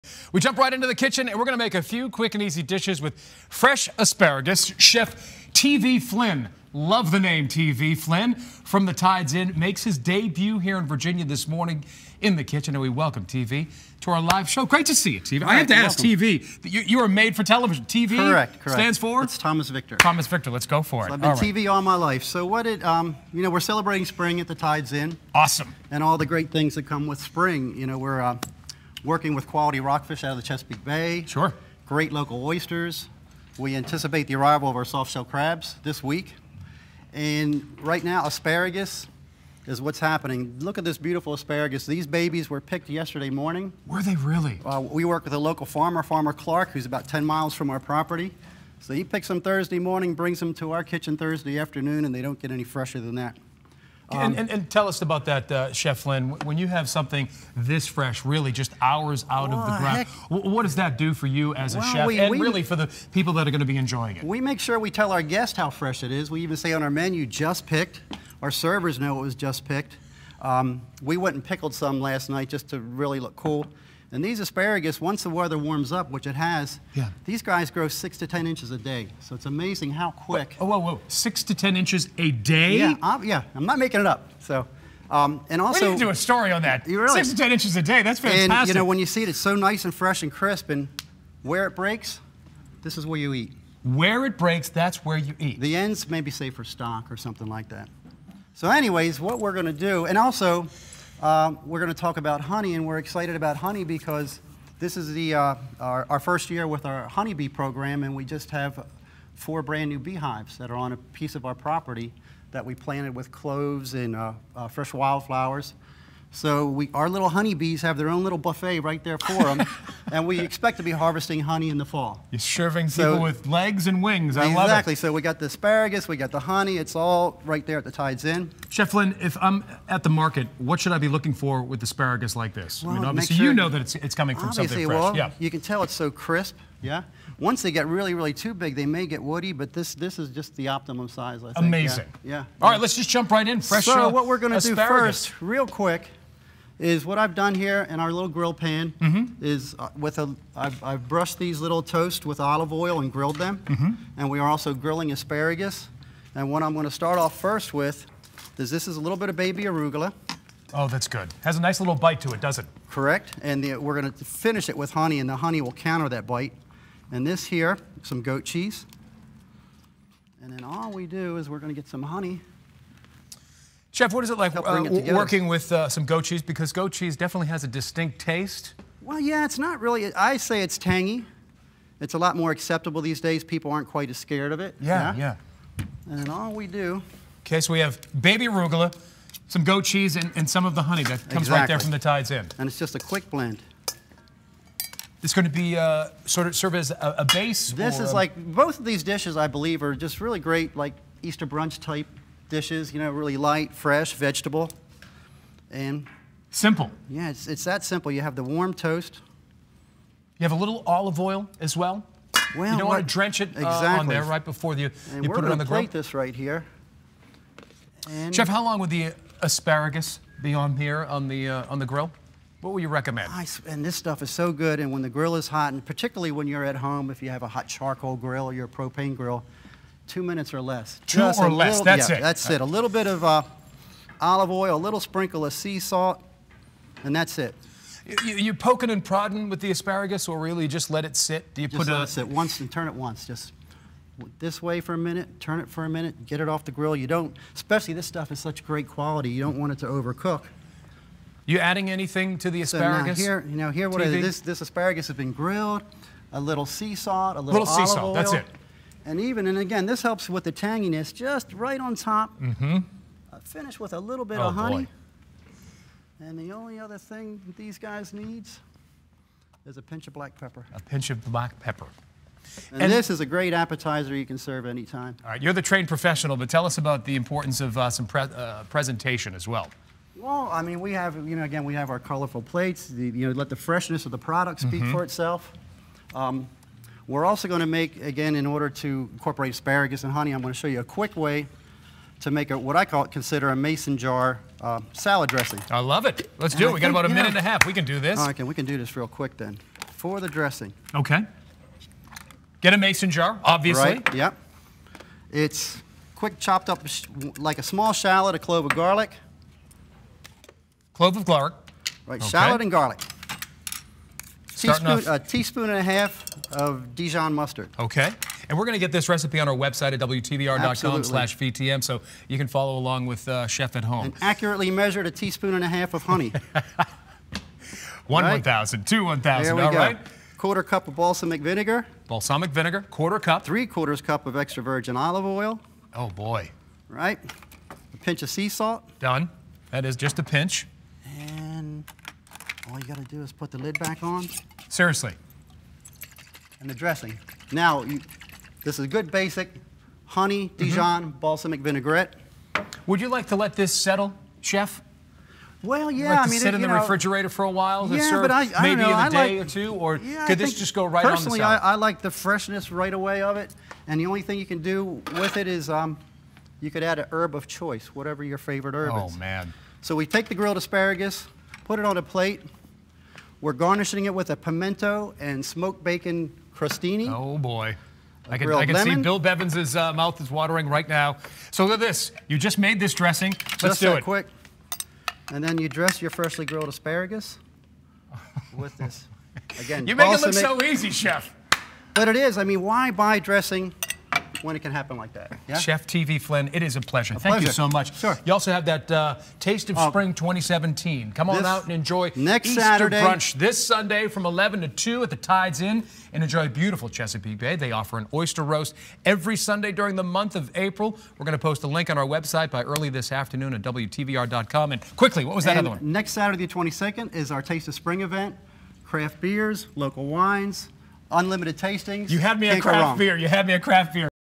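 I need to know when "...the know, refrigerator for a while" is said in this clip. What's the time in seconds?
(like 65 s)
356 s.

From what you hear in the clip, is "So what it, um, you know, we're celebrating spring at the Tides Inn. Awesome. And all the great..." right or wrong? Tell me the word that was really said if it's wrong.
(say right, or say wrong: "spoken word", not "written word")
right.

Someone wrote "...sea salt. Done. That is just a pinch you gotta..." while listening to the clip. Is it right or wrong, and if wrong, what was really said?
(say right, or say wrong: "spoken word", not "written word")
right.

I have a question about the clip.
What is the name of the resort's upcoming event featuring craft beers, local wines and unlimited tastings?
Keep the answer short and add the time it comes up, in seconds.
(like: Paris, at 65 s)
Taste of Spring, at 417 s.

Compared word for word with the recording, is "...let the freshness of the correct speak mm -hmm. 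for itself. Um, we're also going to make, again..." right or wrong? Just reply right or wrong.
wrong.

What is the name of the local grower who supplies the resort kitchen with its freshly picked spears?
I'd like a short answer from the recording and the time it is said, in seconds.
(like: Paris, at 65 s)
Farmer Clark, at 46 s.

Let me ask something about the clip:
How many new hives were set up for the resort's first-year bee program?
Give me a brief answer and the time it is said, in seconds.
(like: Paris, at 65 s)
4, at 109 s.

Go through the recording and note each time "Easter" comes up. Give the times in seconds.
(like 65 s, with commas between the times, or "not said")
201 s, 402 s.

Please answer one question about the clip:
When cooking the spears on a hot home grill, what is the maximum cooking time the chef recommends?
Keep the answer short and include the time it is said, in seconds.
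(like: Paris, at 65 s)
2 minutes, at 230 s.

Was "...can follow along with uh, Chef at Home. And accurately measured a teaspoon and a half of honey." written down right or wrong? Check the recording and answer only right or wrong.
right.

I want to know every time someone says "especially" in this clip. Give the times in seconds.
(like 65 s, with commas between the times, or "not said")
247 s.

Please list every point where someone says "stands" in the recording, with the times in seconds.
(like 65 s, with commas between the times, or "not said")
18 s.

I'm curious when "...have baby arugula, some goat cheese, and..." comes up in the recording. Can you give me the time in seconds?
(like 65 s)
187 s.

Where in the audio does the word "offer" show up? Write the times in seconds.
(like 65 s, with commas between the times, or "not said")
407 s.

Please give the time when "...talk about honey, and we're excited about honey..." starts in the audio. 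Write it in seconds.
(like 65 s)
101 s.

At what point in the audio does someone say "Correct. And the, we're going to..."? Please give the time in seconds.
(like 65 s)
162 s.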